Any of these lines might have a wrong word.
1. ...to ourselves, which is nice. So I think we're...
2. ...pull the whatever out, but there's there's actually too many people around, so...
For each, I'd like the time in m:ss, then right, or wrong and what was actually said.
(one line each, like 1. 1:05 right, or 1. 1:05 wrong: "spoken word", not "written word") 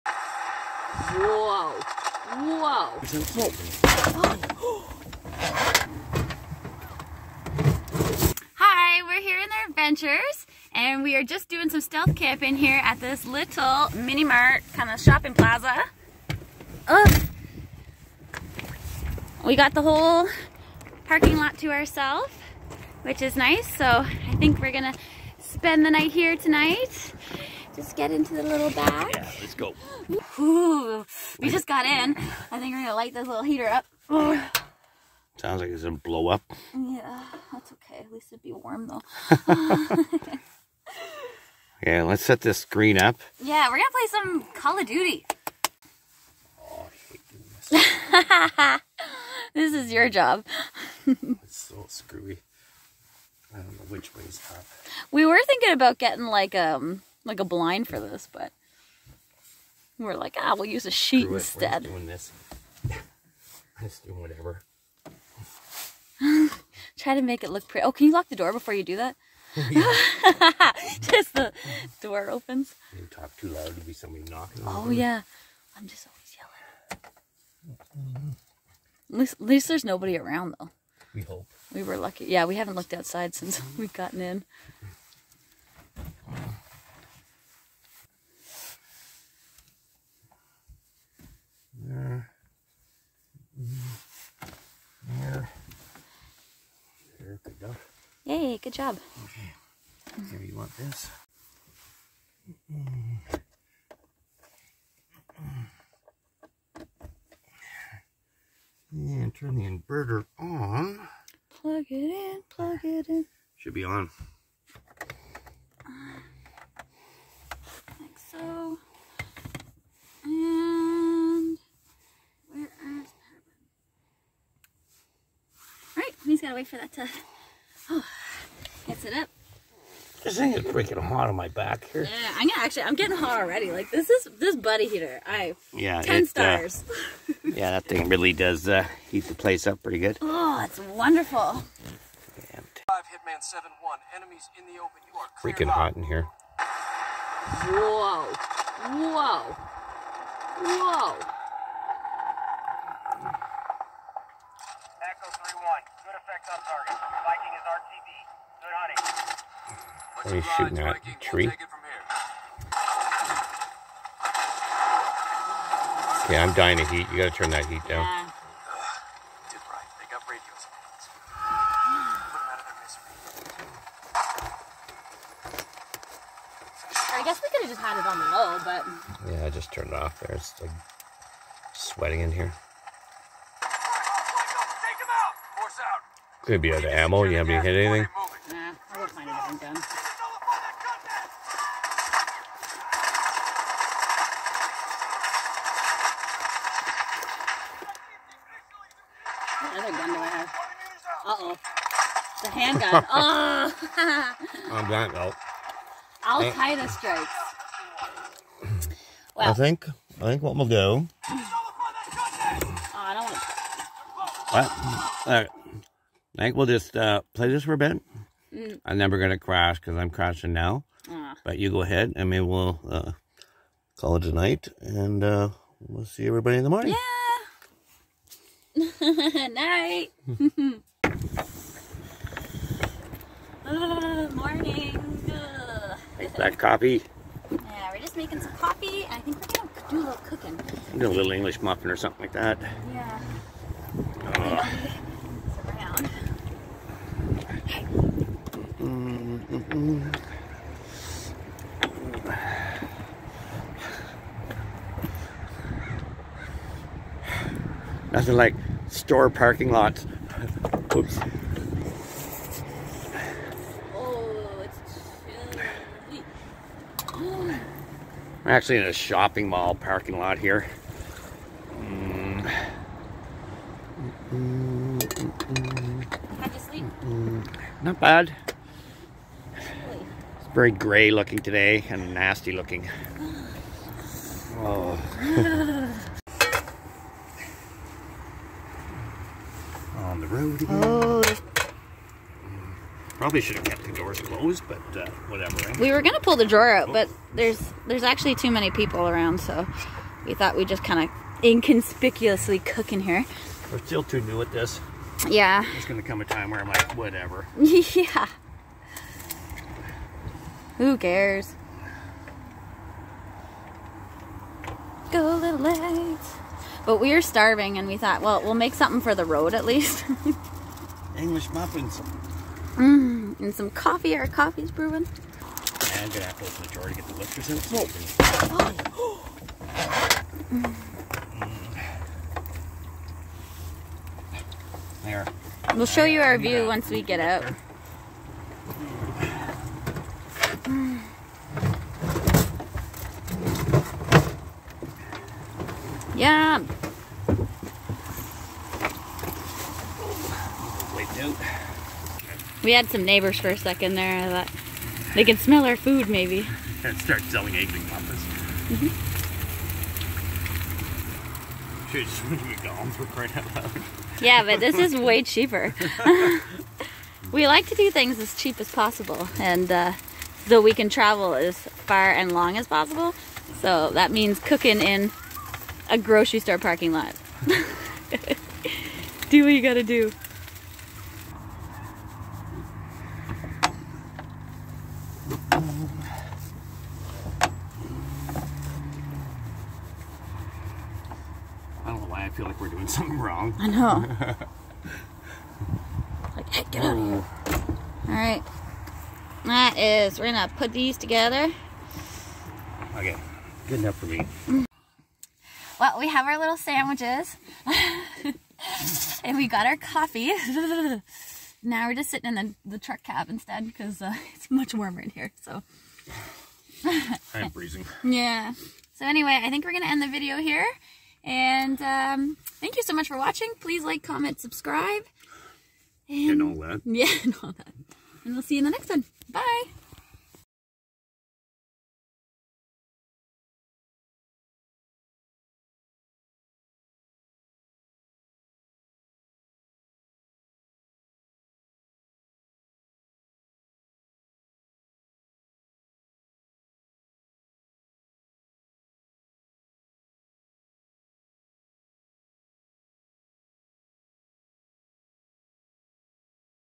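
1. 0:21 right
2. 4:56 wrong: "drawer", not "whatever".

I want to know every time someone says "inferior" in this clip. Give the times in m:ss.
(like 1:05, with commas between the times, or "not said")
not said.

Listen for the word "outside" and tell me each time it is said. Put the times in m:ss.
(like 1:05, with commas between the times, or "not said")
1:22.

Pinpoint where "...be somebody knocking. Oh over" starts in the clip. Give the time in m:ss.
1:13.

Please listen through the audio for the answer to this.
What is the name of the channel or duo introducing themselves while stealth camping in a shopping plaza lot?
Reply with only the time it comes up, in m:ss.
0:09.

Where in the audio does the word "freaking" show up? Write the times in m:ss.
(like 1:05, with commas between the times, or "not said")
2:10, 2:25.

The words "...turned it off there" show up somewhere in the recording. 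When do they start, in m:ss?
2:59.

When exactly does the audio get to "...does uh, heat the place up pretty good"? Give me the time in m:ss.
2:18.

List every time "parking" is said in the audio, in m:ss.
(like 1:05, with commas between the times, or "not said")
0:21, 4:19, 4:29, 6:16.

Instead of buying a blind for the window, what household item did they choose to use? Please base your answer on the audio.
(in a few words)
A sheet.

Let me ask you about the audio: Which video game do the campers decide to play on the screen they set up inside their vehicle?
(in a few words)
Call of Duty.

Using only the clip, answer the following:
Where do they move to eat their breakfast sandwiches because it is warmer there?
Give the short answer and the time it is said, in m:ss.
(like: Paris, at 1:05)
The truck cab, at 6:52.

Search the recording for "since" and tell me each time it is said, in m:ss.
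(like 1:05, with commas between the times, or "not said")
1:23.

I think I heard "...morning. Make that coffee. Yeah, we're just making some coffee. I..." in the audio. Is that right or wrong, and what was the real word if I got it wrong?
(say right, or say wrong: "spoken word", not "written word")
right.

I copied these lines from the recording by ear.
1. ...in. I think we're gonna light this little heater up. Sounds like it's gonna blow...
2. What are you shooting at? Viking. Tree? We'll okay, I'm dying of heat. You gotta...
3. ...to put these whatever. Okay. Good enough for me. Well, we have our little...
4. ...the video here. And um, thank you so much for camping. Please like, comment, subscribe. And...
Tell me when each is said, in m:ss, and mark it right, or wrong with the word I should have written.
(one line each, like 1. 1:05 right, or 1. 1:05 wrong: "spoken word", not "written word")
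1. 0:31 right
2. 2:40 right
3. 6:40 wrong: "together", not "whatever"
4. 7:00 wrong: "watching", not "camping".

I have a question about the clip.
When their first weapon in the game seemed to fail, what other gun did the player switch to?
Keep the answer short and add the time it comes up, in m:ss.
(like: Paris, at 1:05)
The handgun, at 3:22.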